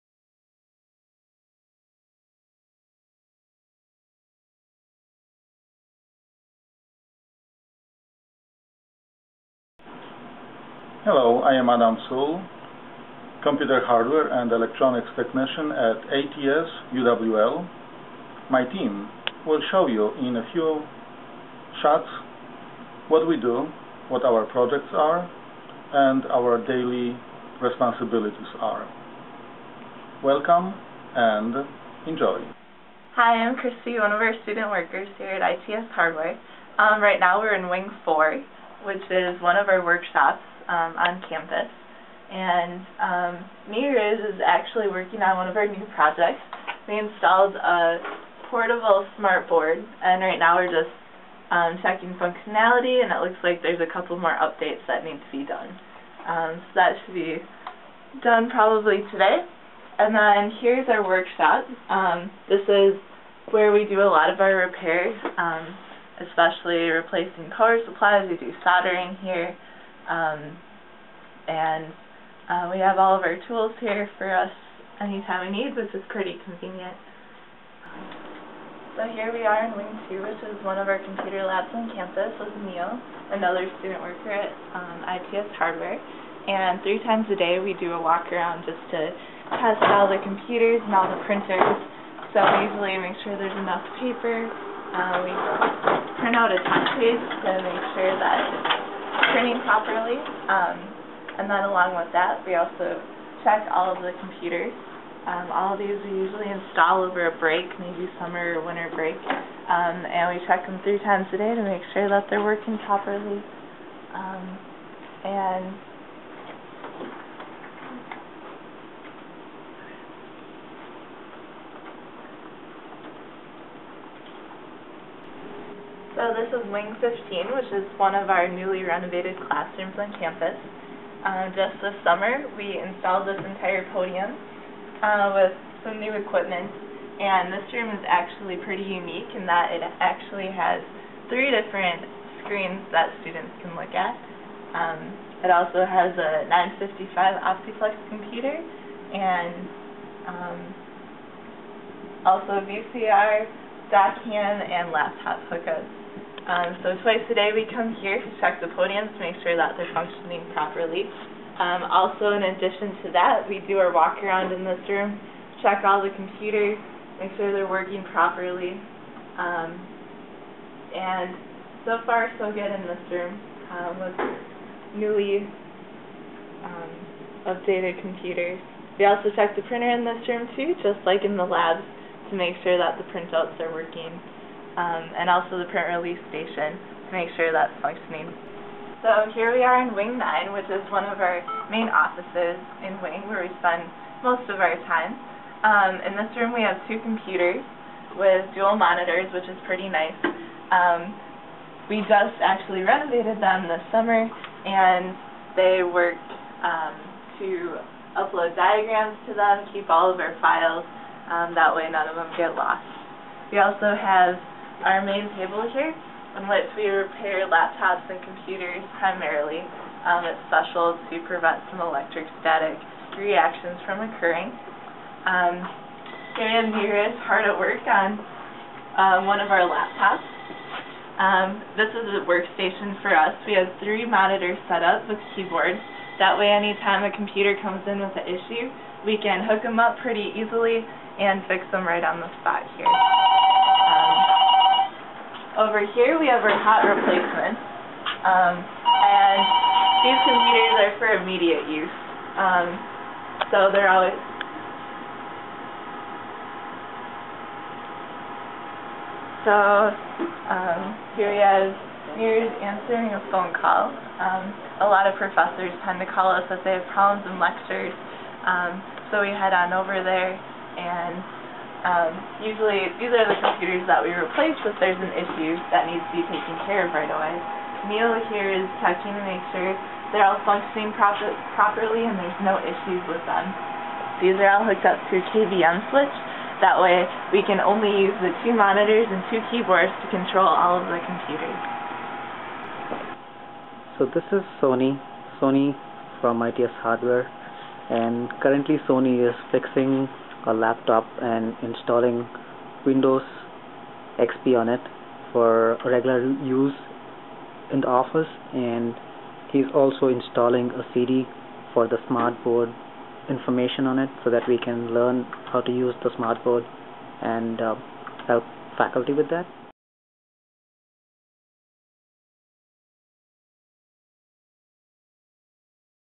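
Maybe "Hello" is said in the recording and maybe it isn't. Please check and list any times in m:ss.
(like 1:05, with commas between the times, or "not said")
0:11.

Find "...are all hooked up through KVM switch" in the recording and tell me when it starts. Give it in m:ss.
4:44.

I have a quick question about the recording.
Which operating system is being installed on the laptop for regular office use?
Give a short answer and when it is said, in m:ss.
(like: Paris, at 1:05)
Windows XP, at 5:02.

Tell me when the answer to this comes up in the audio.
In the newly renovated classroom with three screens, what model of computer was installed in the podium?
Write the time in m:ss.
2:26.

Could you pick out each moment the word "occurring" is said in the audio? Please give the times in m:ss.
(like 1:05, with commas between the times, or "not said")
3:44.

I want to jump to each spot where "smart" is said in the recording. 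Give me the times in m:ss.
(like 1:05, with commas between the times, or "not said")
0:49, 5:12, 5:16.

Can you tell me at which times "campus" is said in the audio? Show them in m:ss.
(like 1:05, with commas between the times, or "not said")
0:41, 1:21, 2:10.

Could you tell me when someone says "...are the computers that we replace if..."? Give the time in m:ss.
4:33.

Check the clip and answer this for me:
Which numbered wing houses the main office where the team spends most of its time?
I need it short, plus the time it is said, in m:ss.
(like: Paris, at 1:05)
Wing 9, at 3:09.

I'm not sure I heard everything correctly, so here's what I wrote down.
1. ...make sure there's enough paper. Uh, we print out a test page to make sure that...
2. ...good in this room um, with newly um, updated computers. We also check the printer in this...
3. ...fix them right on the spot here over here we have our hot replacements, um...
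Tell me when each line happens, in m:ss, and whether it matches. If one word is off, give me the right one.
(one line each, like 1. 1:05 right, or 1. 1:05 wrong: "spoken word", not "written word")
1. 1:32 right
2. 2:52 right
3. 4:01 right.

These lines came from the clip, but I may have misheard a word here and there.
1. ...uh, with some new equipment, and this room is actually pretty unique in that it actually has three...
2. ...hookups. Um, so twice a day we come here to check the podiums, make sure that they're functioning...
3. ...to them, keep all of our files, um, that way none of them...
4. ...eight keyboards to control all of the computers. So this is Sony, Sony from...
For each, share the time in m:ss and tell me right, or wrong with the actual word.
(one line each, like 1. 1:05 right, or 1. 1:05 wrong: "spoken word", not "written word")
1. 2:15 right
2. 2:35 right
3. 3:29 right
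4. 4:49 wrong: "two", not "eight".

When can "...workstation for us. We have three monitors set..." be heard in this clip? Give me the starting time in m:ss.
3:52.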